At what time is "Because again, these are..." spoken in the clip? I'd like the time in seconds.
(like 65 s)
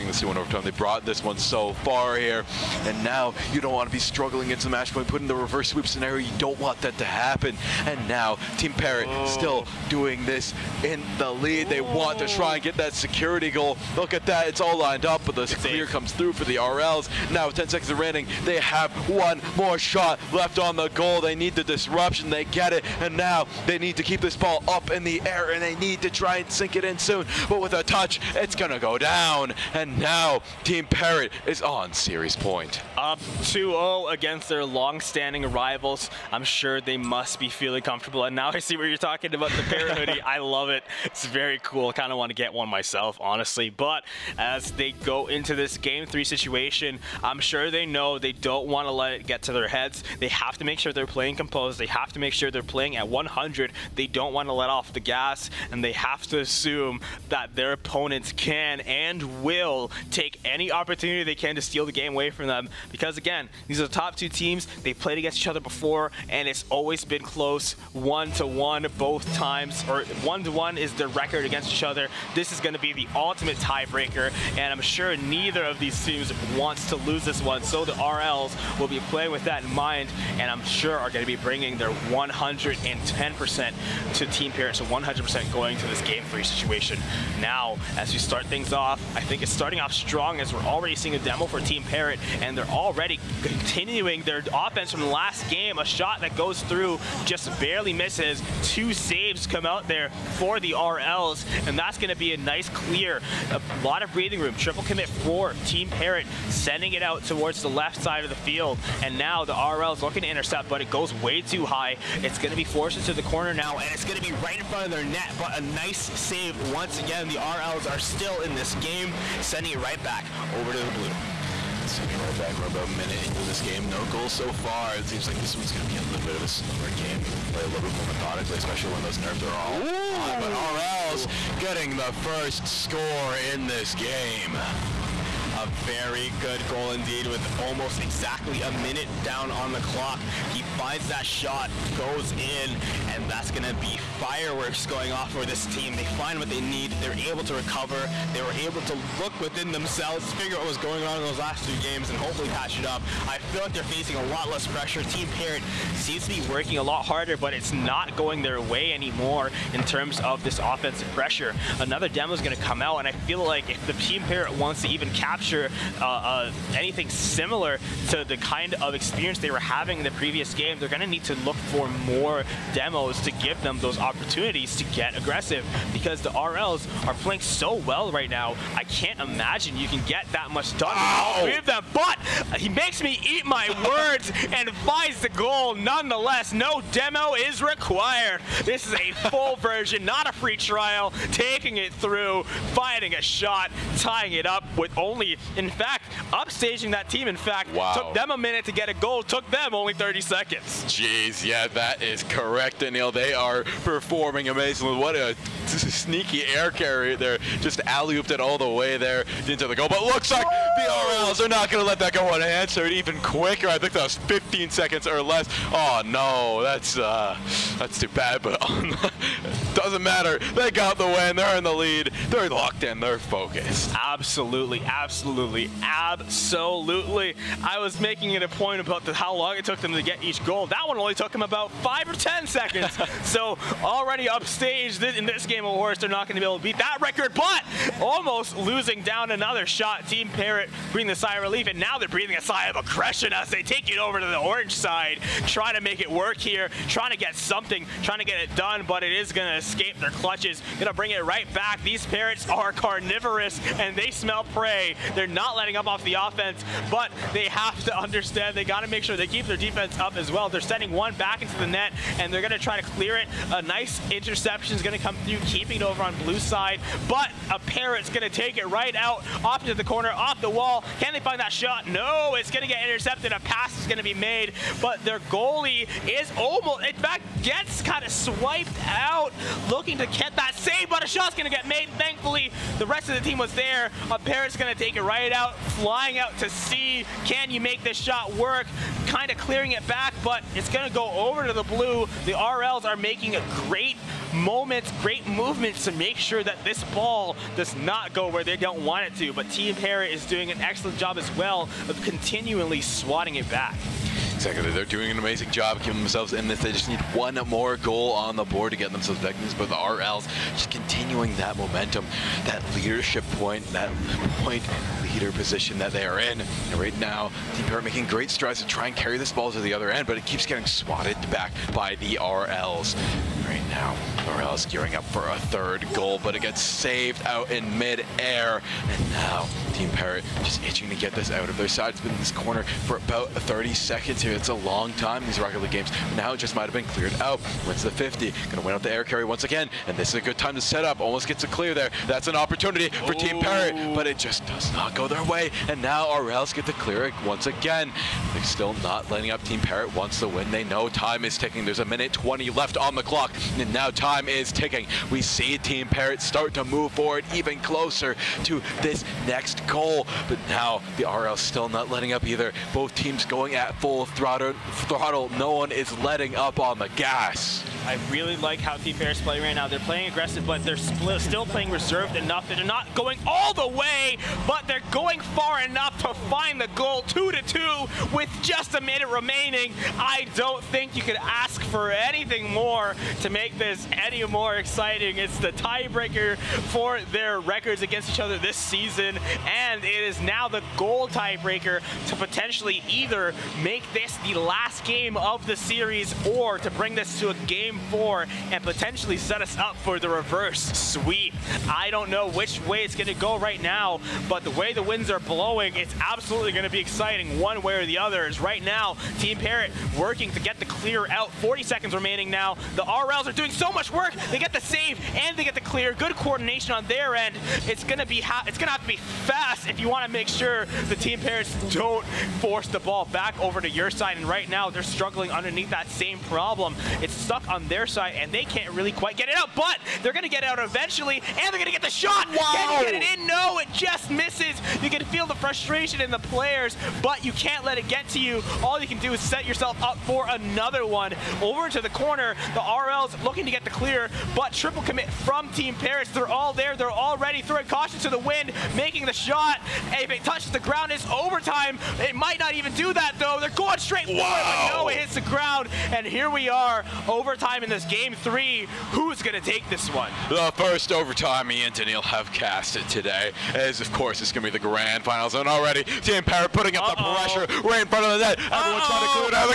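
62 s.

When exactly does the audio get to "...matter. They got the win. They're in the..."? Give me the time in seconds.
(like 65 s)
220 s.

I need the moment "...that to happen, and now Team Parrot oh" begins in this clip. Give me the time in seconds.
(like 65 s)
6 s.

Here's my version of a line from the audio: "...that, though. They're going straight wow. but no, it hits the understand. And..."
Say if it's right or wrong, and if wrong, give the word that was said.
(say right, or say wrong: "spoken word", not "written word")
wrong: "ground", not "understand".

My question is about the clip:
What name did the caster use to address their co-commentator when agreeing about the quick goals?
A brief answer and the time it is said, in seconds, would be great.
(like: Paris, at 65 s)
Anil, at 202 s.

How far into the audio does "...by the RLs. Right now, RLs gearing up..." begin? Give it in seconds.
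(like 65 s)
321 s.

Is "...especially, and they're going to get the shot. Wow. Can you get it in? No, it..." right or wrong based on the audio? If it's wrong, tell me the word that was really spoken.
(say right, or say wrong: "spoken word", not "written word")
wrong: "eventually", not "especially".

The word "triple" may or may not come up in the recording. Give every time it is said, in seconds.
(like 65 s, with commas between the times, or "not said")
104 s, 444 s.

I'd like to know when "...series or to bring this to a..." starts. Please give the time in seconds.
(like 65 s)
395 s.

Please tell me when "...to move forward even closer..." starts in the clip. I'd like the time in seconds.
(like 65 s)
356 s.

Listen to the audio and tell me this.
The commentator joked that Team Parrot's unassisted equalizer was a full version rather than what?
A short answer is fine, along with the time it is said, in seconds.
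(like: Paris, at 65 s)
a free trial, at 190 s.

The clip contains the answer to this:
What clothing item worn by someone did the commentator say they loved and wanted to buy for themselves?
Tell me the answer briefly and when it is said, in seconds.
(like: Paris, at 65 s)
bear hoodie, at 39 s.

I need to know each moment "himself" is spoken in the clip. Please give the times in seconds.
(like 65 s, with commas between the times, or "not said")
not said.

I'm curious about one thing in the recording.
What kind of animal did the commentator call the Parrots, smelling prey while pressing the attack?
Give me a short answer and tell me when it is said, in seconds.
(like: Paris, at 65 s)
carnivorous, at 251 s.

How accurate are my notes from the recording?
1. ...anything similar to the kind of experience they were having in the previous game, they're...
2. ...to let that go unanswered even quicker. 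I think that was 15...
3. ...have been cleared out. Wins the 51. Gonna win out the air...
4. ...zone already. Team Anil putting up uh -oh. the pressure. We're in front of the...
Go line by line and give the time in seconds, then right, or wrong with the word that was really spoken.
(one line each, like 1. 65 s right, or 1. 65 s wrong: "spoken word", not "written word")
1. 166 s right
2. 211 s right
3. 336 s wrong: "50", not "51"
4. 465 s wrong: "Parrot", not "Anil".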